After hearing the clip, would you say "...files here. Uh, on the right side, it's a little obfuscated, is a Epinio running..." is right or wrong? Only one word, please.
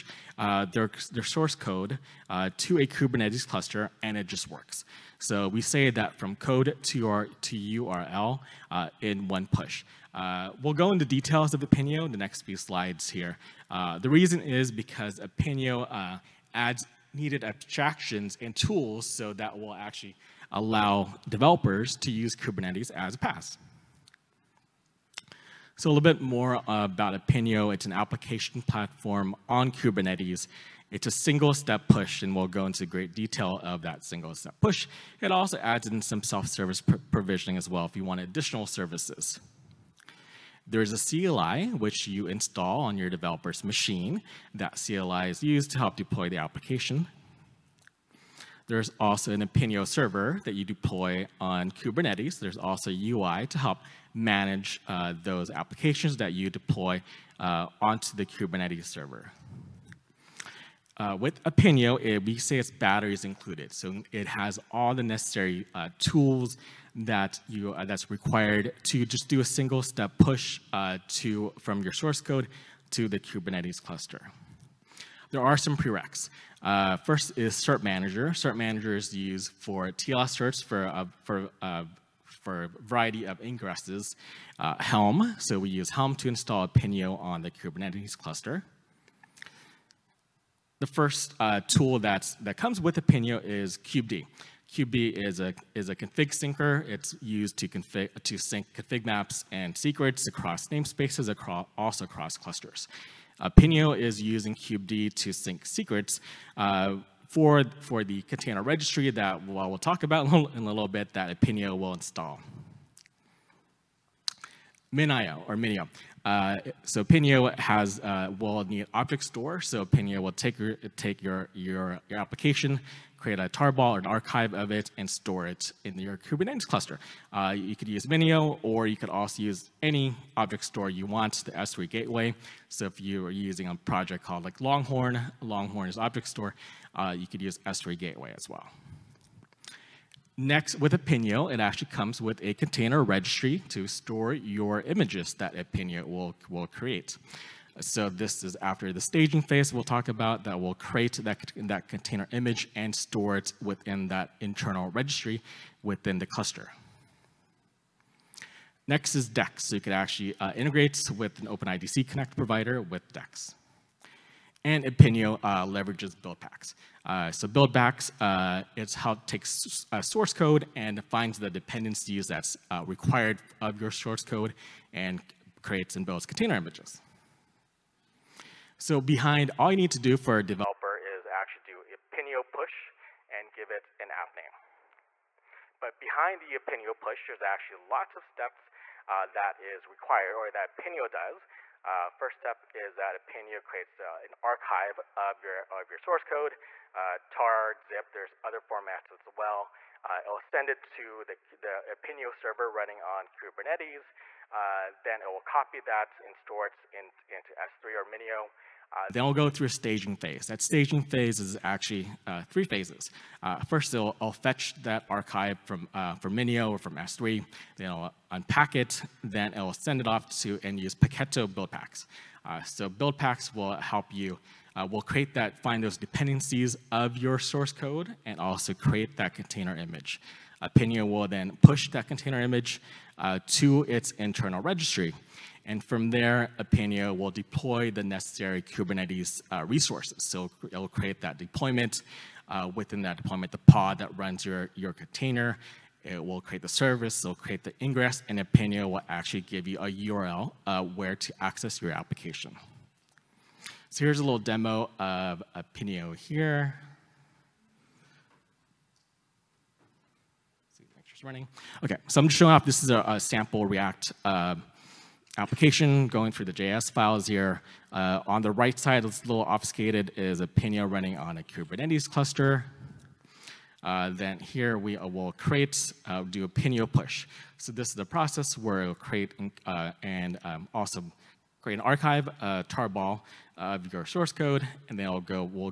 right.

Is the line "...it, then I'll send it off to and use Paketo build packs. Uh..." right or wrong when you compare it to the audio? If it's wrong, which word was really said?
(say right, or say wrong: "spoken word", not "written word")
right.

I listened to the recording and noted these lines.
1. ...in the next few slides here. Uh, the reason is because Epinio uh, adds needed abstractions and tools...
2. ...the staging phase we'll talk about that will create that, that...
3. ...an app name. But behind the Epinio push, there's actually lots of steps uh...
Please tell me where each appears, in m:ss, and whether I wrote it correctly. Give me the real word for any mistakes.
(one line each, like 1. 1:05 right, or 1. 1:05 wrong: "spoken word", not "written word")
1. 0:12 right
2. 2:28 right
3. 3:03 right.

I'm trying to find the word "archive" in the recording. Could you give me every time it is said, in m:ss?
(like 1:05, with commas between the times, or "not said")
2:04, 3:14, 3:35, 4:41.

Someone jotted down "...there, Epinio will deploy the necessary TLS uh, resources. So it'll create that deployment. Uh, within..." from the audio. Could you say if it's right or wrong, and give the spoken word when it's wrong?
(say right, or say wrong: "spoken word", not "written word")
wrong: "Kubernetes", not "TLS".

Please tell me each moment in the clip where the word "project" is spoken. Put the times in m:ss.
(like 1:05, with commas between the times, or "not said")
2:13.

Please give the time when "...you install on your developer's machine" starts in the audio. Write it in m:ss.
0:42.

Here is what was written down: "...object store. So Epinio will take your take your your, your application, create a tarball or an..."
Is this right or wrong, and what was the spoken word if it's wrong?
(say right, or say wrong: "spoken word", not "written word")
right.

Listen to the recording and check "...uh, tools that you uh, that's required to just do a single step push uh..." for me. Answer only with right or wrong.
right.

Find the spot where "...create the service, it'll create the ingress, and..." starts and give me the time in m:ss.
4:06.